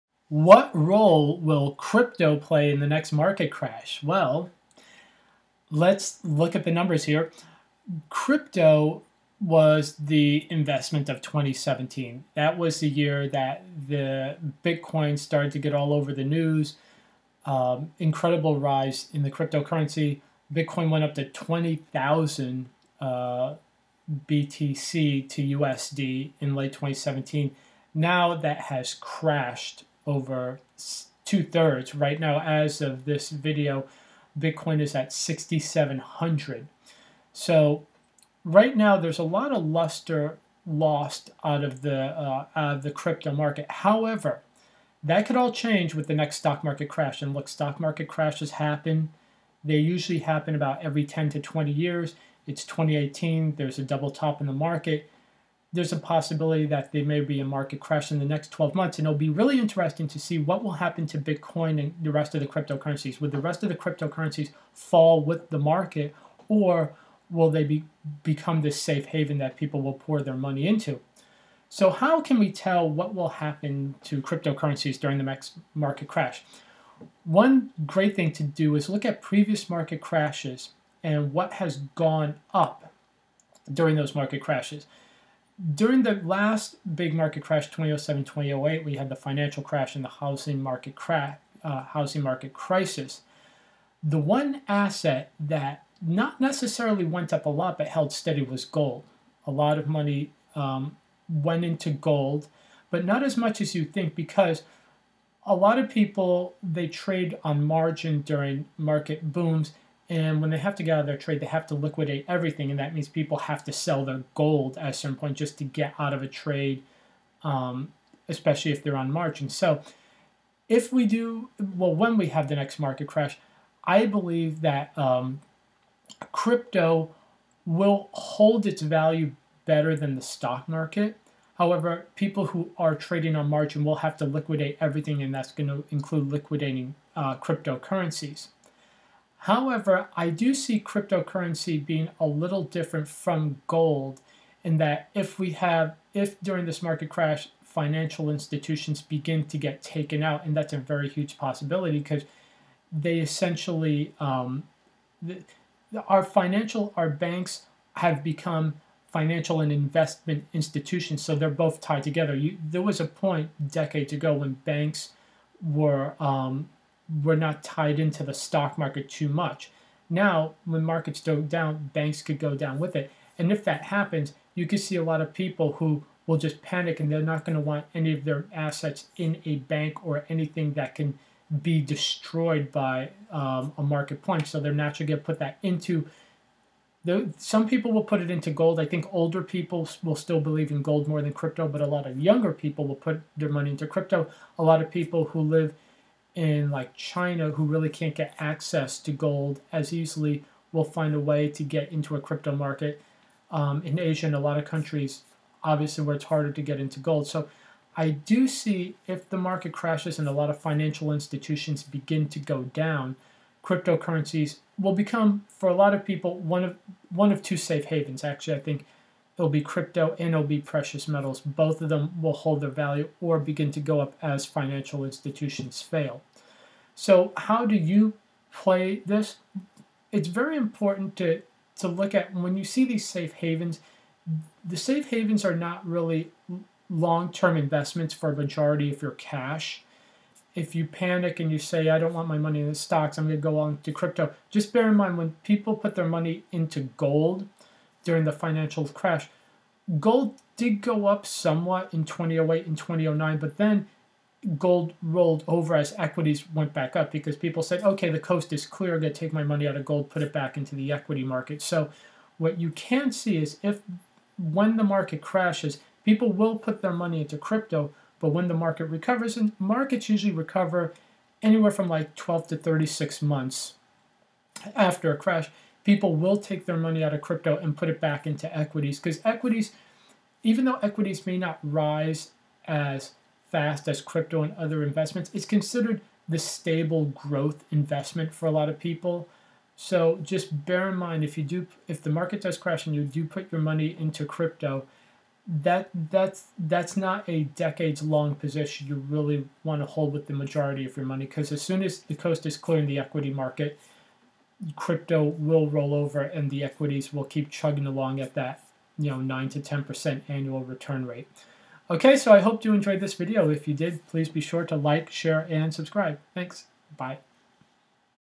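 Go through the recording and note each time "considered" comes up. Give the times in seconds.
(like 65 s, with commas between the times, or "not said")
285 s.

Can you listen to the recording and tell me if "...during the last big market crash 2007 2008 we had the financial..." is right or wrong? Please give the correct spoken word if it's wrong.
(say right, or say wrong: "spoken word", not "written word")
right.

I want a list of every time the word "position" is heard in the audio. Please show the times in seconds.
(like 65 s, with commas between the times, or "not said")
298 s.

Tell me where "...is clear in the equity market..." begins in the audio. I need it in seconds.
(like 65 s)
302 s.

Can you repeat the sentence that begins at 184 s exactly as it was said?
So they're naturally going to put that into.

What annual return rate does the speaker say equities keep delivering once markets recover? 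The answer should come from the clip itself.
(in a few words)
9 to 10%.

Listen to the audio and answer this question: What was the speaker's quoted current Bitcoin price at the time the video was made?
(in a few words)
6,700.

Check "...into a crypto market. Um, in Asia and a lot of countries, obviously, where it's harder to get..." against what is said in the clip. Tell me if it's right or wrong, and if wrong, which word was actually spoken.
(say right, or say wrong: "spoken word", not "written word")
right.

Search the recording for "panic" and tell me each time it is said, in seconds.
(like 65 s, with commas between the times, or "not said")
176 s, 240 s.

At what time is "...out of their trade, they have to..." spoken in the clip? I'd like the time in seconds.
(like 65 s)
110 s.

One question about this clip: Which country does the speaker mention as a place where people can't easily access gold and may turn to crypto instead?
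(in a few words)
China.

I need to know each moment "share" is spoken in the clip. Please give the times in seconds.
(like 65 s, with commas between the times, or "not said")
315 s.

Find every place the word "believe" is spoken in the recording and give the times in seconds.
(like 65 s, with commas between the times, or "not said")
124 s, 190 s.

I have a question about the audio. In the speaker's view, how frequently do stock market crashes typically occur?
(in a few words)
every 10 to 20 years.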